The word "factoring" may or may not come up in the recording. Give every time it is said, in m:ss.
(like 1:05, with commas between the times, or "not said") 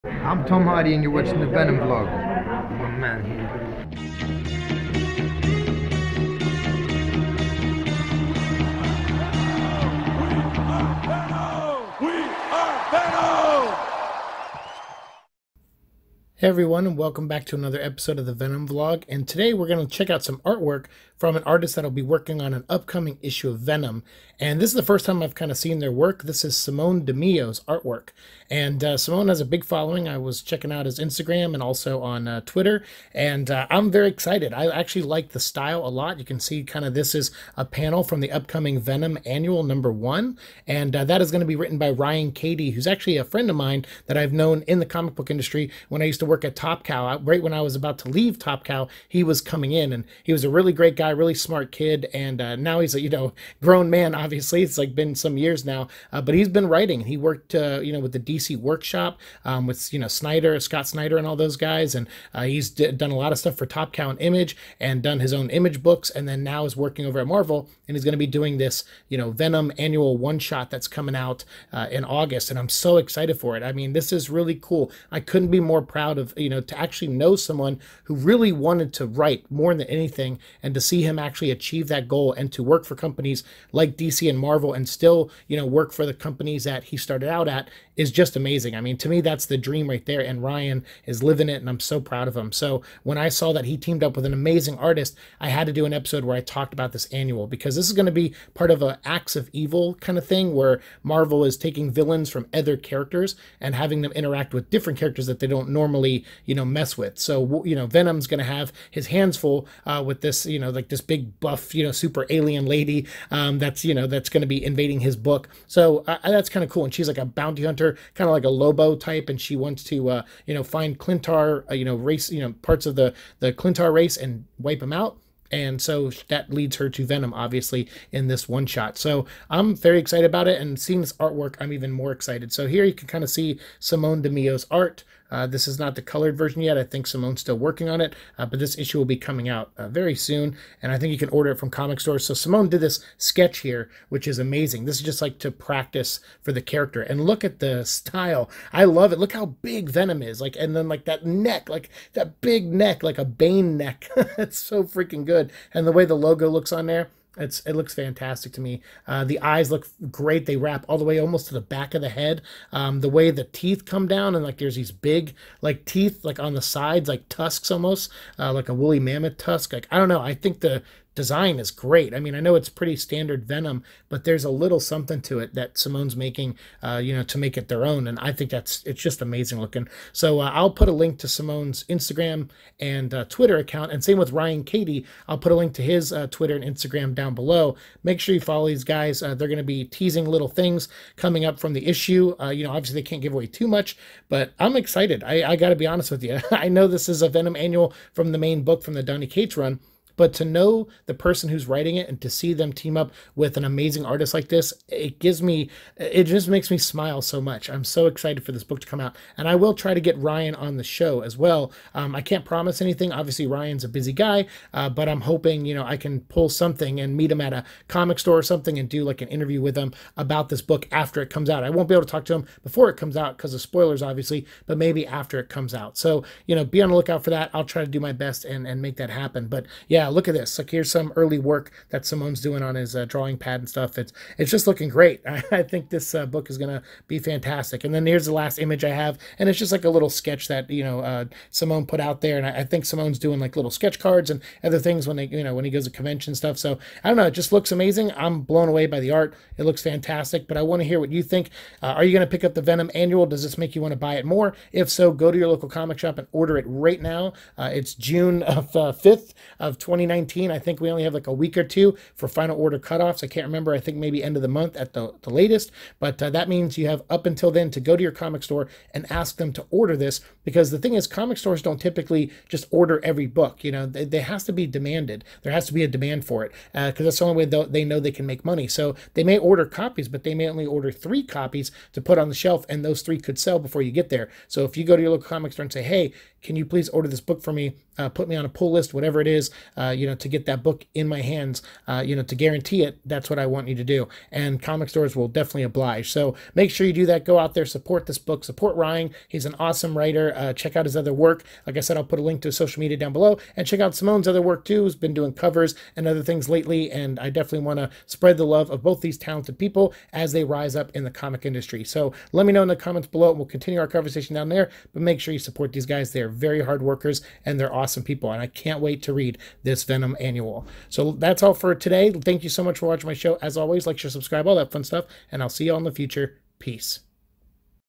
not said.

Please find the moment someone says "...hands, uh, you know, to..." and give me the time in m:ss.
4:51.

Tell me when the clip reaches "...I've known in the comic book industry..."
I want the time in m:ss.
0:44.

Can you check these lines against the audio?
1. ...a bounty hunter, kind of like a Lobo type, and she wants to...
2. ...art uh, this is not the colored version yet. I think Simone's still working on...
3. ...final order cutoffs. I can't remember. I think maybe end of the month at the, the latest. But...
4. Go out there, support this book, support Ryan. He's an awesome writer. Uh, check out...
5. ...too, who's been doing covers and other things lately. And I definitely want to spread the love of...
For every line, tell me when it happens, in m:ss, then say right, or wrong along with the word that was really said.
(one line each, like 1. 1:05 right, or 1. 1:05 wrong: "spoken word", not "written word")
1. 1:57 right
2. 2:14 right
3. 4:22 right
4. 4:57 right
5. 5:04 right.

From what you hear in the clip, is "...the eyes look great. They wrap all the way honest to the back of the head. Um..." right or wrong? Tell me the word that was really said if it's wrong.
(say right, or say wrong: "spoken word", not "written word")
wrong: "almost", not "honest".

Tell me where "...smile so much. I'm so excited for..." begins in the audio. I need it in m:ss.
3:26.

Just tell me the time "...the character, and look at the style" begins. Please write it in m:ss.
2:26.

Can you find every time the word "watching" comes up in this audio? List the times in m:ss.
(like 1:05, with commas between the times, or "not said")
0:01, 5:22.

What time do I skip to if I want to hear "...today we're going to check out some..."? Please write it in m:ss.
0:19.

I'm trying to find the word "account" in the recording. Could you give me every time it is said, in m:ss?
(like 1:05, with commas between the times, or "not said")
3:03.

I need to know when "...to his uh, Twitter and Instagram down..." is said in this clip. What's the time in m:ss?
3:05.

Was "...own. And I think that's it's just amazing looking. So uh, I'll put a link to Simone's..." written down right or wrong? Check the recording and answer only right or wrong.
right.